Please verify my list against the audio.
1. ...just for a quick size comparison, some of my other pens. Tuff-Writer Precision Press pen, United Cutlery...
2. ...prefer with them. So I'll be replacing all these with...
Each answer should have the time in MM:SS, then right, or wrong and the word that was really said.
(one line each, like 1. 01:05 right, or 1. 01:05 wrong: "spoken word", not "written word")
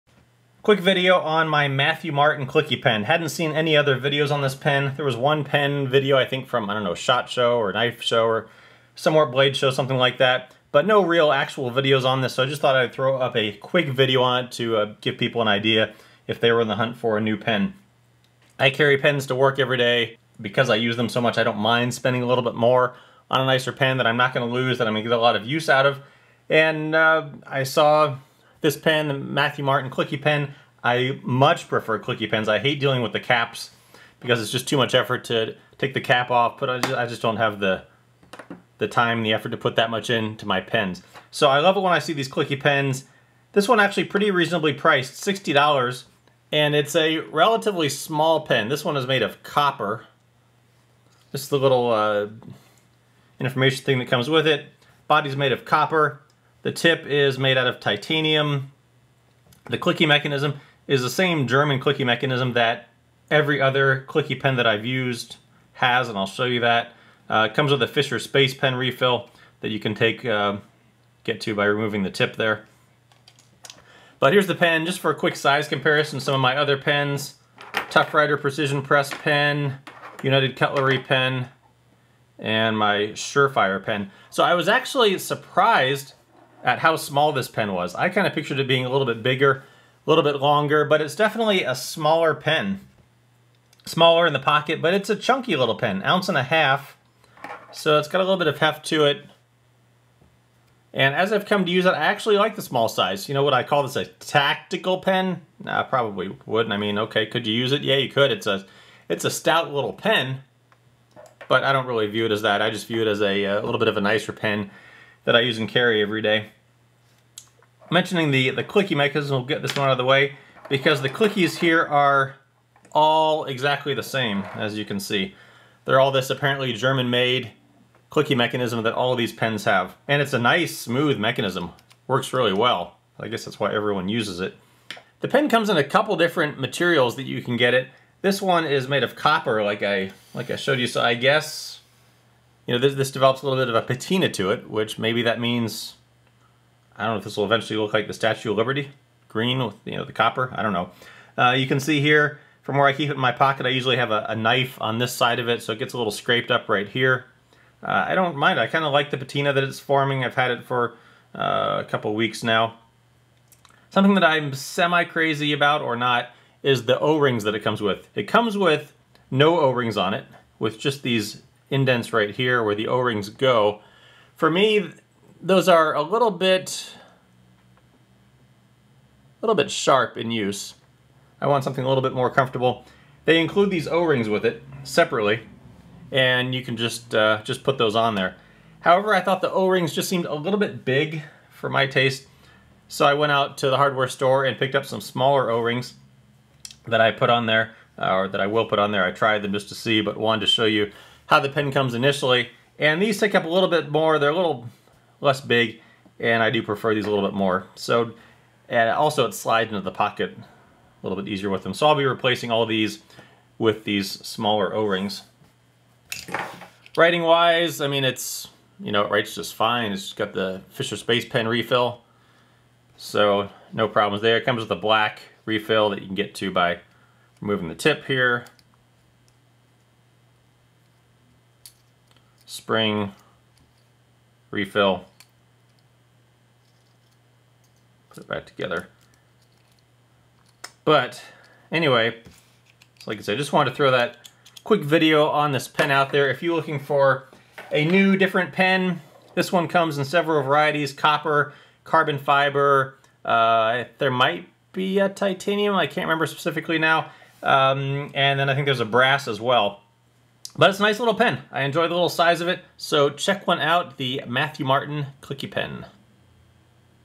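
1. 01:14 right
2. 03:31 wrong: "easier", not "prefer".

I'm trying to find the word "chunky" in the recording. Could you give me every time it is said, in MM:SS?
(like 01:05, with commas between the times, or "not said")
01:35.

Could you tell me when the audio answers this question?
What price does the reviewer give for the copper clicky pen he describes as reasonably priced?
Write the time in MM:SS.
00:45.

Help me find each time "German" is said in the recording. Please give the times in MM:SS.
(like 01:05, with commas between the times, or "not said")
01:01, 02:06.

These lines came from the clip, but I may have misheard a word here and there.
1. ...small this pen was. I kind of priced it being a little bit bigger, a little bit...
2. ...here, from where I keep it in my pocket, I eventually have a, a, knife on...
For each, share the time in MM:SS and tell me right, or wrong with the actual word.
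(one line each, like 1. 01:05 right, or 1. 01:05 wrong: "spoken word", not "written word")
1. 01:26 wrong: "pictured", not "priced"
2. 02:31 wrong: "usually", not "eventually".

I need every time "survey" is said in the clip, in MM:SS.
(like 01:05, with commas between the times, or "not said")
not said.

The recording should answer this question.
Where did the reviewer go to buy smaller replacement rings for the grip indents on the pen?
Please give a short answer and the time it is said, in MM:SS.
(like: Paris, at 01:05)
The hardware store, at 03:13.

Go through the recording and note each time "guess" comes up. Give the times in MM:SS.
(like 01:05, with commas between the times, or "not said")
02:13, 02:21.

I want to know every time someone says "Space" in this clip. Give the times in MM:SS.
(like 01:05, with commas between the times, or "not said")
01:08, 03:40.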